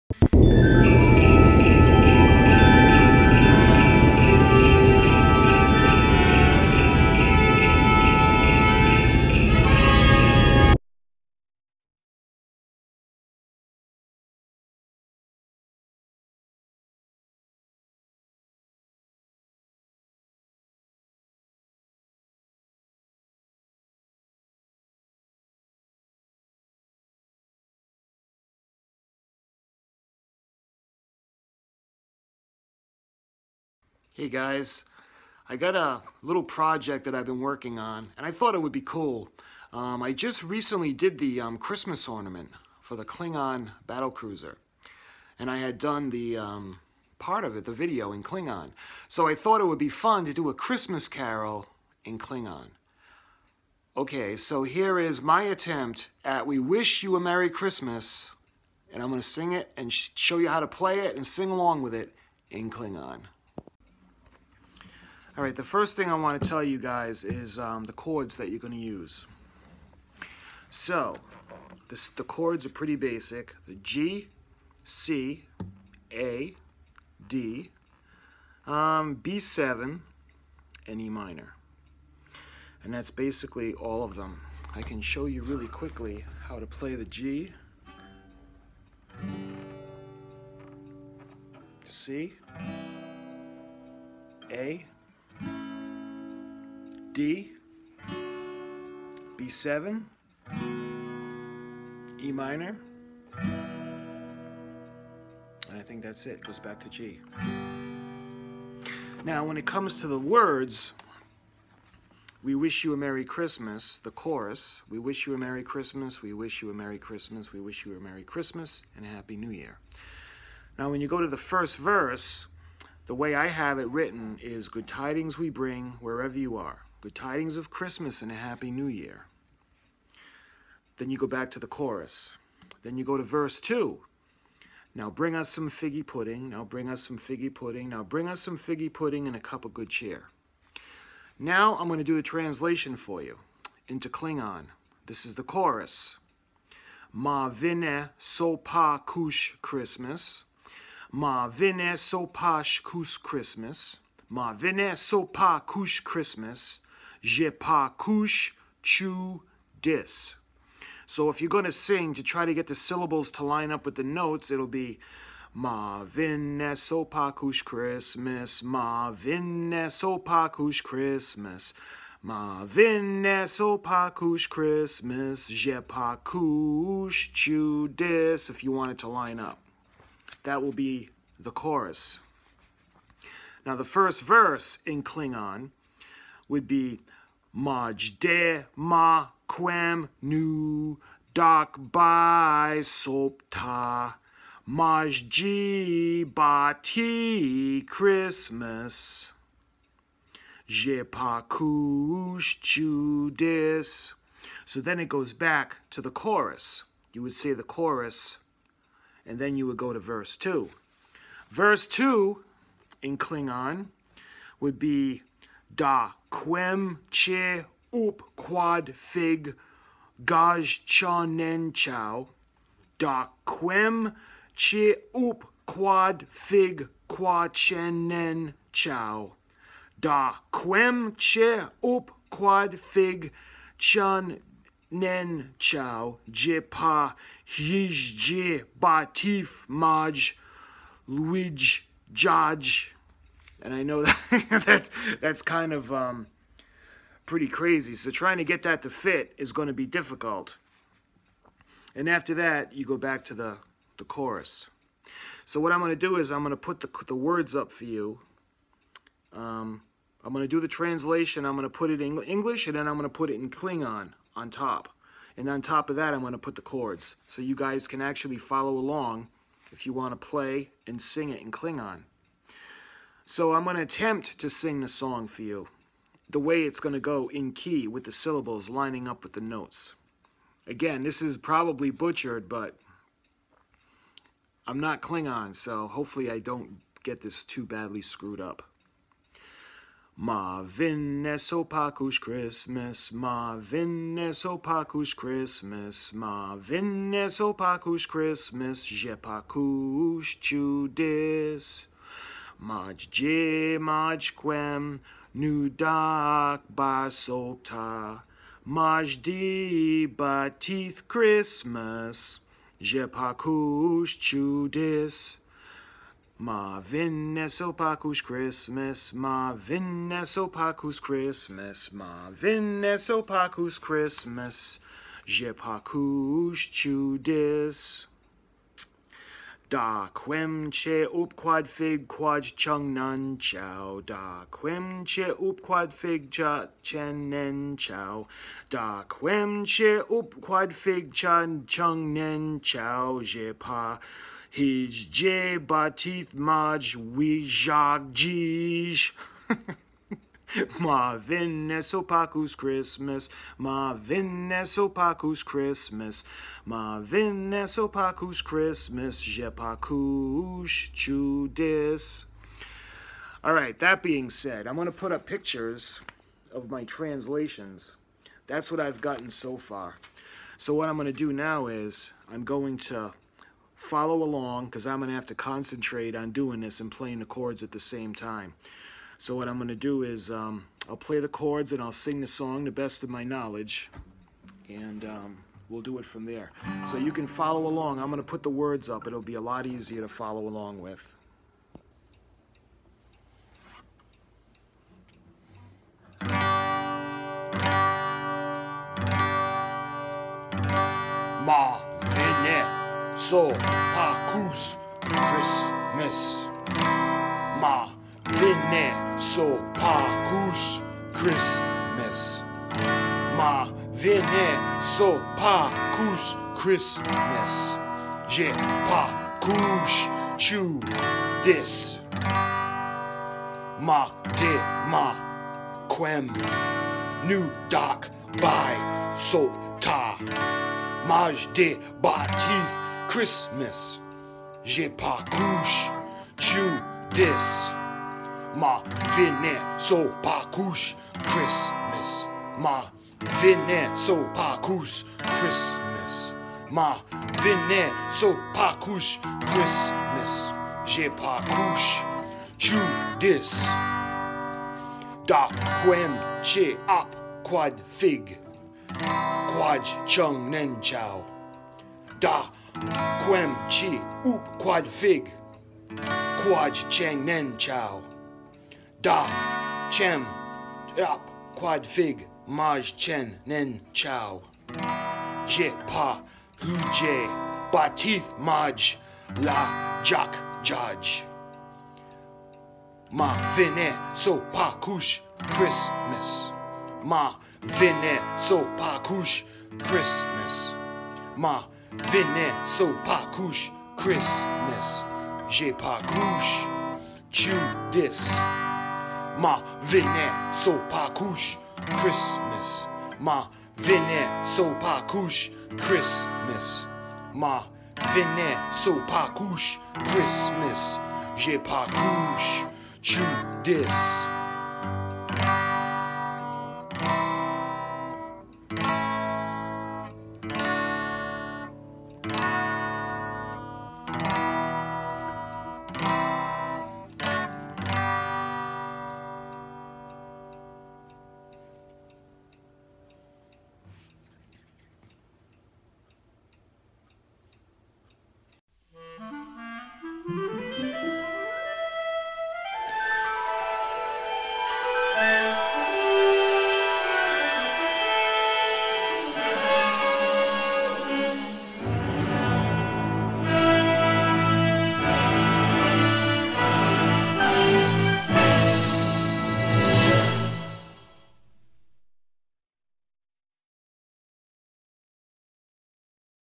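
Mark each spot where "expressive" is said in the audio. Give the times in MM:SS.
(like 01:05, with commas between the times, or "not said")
not said.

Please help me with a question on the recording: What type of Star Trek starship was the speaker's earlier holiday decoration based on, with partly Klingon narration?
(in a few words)
Klingon battle cruiser.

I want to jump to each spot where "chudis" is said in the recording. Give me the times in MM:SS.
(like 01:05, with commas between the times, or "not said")
05:00, 05:14, 05:26, 06:00.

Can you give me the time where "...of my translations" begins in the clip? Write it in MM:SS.
06:06.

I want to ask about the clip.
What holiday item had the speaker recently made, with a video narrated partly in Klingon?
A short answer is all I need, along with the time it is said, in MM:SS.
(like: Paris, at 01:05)
Christmas ornament, at 00:41.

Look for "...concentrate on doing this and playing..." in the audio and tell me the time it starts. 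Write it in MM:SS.
06:15.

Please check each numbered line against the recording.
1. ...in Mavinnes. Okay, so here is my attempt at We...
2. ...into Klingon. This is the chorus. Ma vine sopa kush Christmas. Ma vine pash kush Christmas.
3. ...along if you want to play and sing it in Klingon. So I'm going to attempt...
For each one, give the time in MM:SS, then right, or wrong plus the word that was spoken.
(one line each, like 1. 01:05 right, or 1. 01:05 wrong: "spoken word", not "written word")
1. 00:52 wrong: "Klingon", not "Mavinnes"
2. 02:23 right
3. 04:28 right.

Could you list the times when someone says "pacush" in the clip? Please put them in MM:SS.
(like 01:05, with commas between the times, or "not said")
05:25, 05:59.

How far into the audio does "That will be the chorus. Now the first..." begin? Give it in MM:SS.
03:00.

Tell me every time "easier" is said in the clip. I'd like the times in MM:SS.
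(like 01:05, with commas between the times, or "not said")
06:29.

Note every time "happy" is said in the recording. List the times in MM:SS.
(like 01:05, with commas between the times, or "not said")
01:59, 02:08.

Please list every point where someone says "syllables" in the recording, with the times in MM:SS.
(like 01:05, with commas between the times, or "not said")
02:42, 04:38.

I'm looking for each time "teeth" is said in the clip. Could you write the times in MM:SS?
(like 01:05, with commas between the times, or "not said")
05:45.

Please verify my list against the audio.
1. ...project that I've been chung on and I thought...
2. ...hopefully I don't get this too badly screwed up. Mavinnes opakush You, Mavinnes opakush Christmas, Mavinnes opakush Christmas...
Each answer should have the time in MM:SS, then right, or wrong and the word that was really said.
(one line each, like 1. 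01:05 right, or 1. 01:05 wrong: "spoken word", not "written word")
1. 00:36 wrong: "working", not "chung"
2. 04:45 wrong: "Christmas", not "You".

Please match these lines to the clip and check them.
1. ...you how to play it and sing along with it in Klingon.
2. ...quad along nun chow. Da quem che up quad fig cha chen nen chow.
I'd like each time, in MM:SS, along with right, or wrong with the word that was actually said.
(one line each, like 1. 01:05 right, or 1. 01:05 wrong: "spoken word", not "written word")
1. 01:00 right
2. 05:32 wrong: "chung", not "along".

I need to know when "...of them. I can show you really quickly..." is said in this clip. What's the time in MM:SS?
01:24.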